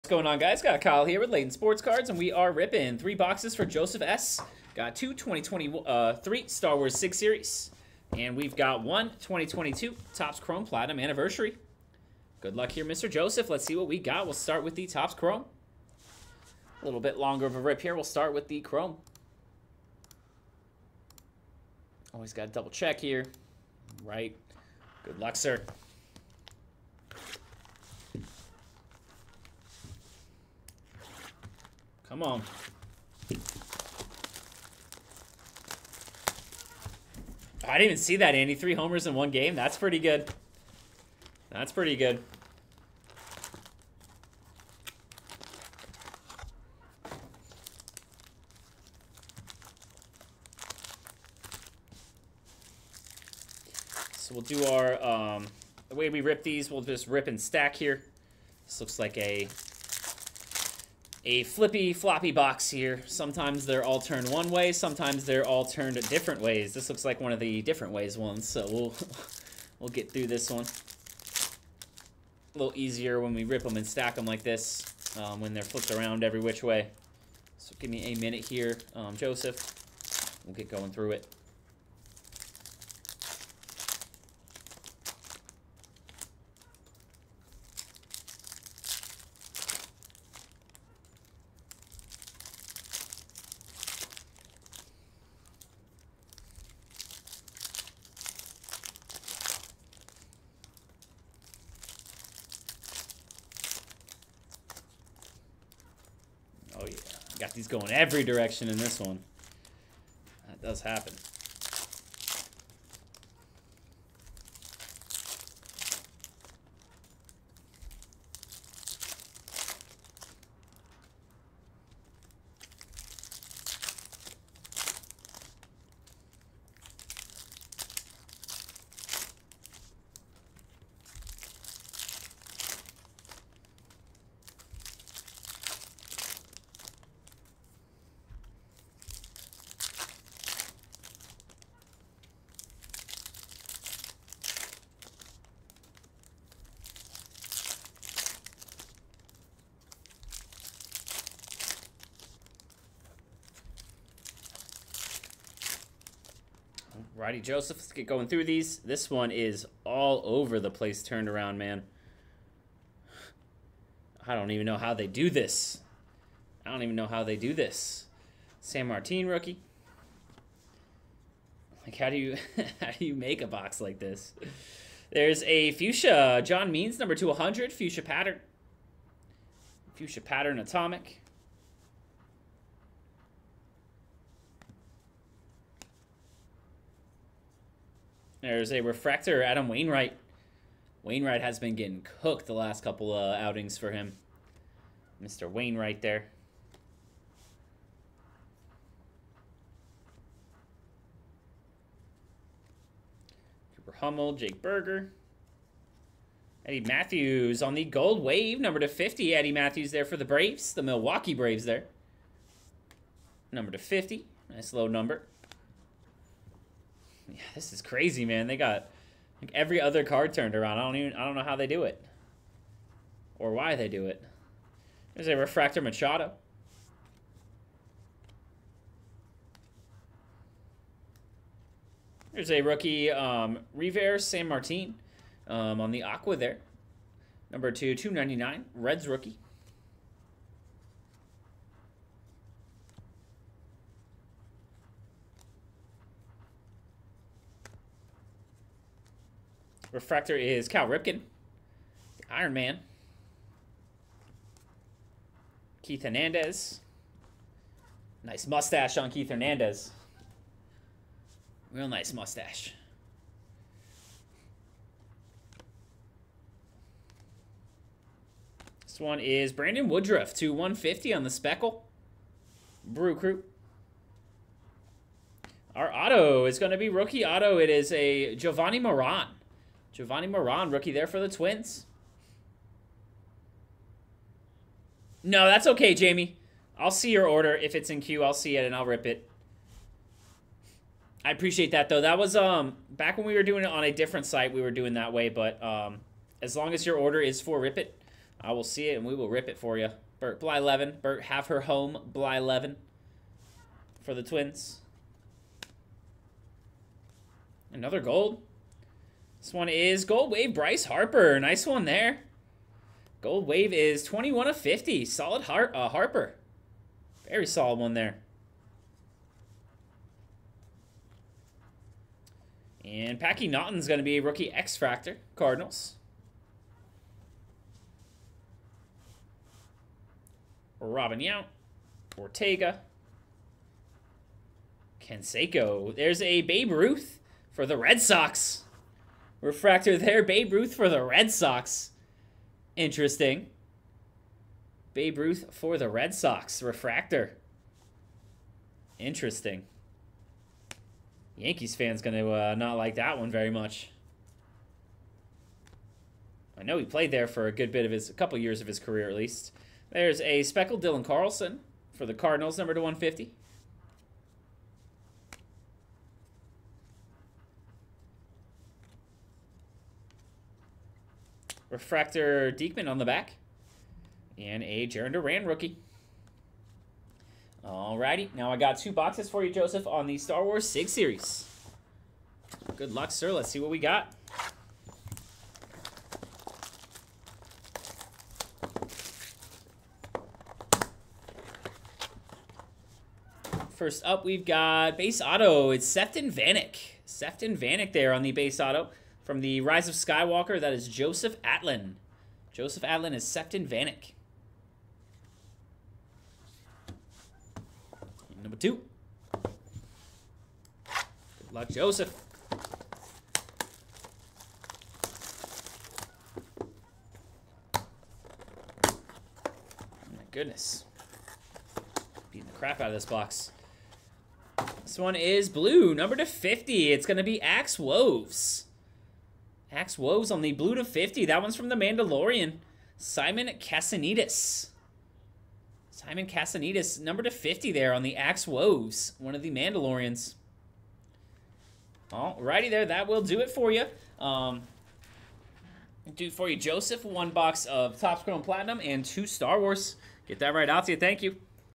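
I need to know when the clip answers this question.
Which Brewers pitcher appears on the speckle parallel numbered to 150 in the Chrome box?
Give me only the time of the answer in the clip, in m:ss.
4:29.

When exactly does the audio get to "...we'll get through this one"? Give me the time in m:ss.
1:09.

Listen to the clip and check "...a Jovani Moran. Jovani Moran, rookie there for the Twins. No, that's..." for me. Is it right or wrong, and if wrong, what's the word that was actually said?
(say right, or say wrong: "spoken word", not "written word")
right.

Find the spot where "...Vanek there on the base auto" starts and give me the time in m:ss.
6:37.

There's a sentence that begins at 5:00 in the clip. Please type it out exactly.
Bert Blyleven, Bert have her home Blyleven for the Twins.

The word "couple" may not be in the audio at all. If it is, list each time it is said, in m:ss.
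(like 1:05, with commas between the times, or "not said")
3:12, 5:58.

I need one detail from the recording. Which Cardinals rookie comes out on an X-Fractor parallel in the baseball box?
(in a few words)
Packy Naughton.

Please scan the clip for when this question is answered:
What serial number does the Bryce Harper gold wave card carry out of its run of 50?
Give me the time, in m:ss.
5:14.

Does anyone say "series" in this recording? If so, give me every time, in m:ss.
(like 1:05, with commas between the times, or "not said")
0:07, 6:20.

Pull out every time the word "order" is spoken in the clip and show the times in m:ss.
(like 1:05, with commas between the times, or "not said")
4:47, 4:56.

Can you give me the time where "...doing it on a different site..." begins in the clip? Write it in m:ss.
4:53.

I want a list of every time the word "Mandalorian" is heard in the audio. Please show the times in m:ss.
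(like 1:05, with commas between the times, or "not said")
7:11, 7:19.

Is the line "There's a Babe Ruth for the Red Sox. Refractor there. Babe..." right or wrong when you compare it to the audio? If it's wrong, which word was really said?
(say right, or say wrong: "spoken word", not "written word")
right.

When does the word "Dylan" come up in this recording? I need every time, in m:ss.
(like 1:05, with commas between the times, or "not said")
6:00.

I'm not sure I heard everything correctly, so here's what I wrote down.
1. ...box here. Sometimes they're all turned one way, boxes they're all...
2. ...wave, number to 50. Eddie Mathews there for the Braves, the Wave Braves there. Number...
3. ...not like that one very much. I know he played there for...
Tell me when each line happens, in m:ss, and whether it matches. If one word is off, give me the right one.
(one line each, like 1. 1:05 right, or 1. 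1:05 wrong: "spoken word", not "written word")
1. 1:02 wrong: "sometimes", not "boxes"
2. 3:28 wrong: "Milwaukee", not "Wave"
3. 5:52 right.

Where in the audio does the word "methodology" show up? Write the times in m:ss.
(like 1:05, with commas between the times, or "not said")
not said.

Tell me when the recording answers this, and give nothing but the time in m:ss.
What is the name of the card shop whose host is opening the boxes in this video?
0:01.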